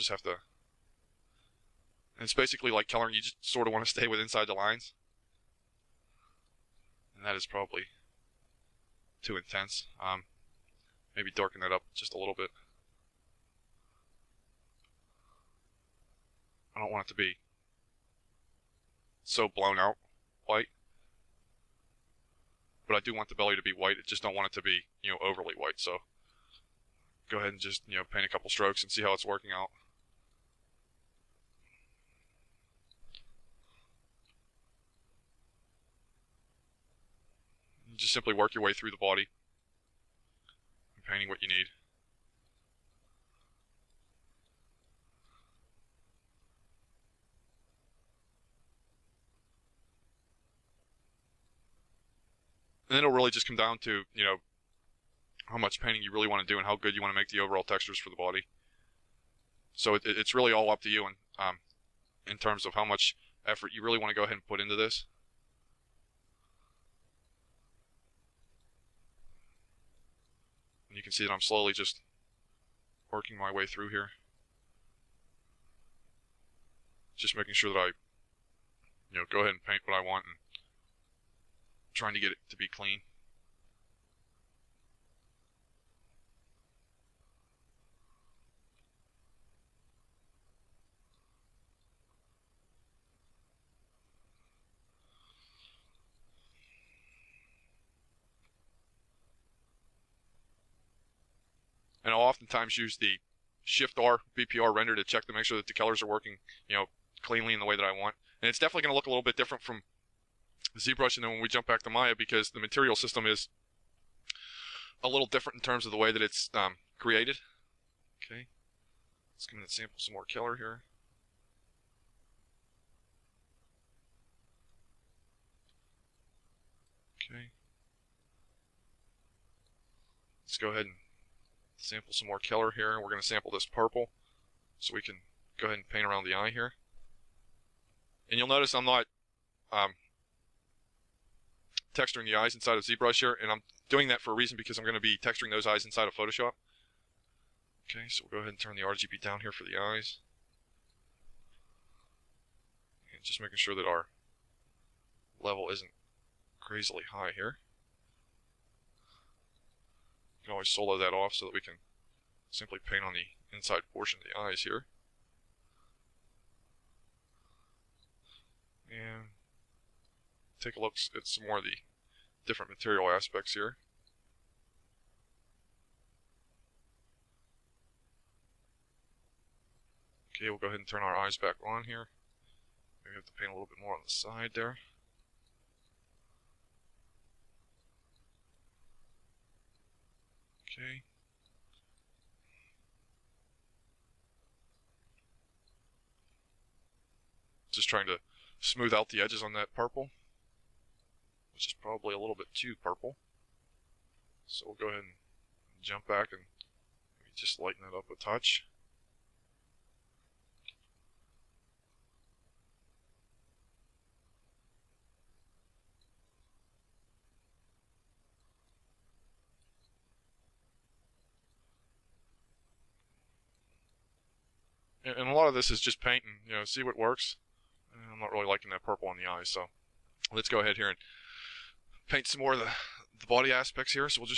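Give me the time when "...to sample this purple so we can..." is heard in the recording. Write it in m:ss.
2:13.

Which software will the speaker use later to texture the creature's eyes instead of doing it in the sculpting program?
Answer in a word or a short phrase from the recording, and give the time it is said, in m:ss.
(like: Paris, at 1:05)
Photoshop, at 2:26.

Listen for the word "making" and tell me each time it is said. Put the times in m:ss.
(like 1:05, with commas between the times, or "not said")
1:17, 2:33.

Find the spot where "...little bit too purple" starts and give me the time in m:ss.
3:22.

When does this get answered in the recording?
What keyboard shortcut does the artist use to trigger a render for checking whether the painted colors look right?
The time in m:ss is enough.
1:43.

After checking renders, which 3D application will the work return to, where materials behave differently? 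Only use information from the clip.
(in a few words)
Maya.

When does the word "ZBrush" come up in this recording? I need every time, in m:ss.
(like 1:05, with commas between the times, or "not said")
1:50, 2:22.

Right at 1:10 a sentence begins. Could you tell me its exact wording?
And you can see that I'm slowly just working my way through here.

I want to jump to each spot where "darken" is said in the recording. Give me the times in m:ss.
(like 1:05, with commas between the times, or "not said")
0:11.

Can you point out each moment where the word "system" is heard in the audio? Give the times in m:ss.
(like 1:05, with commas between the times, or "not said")
1:52.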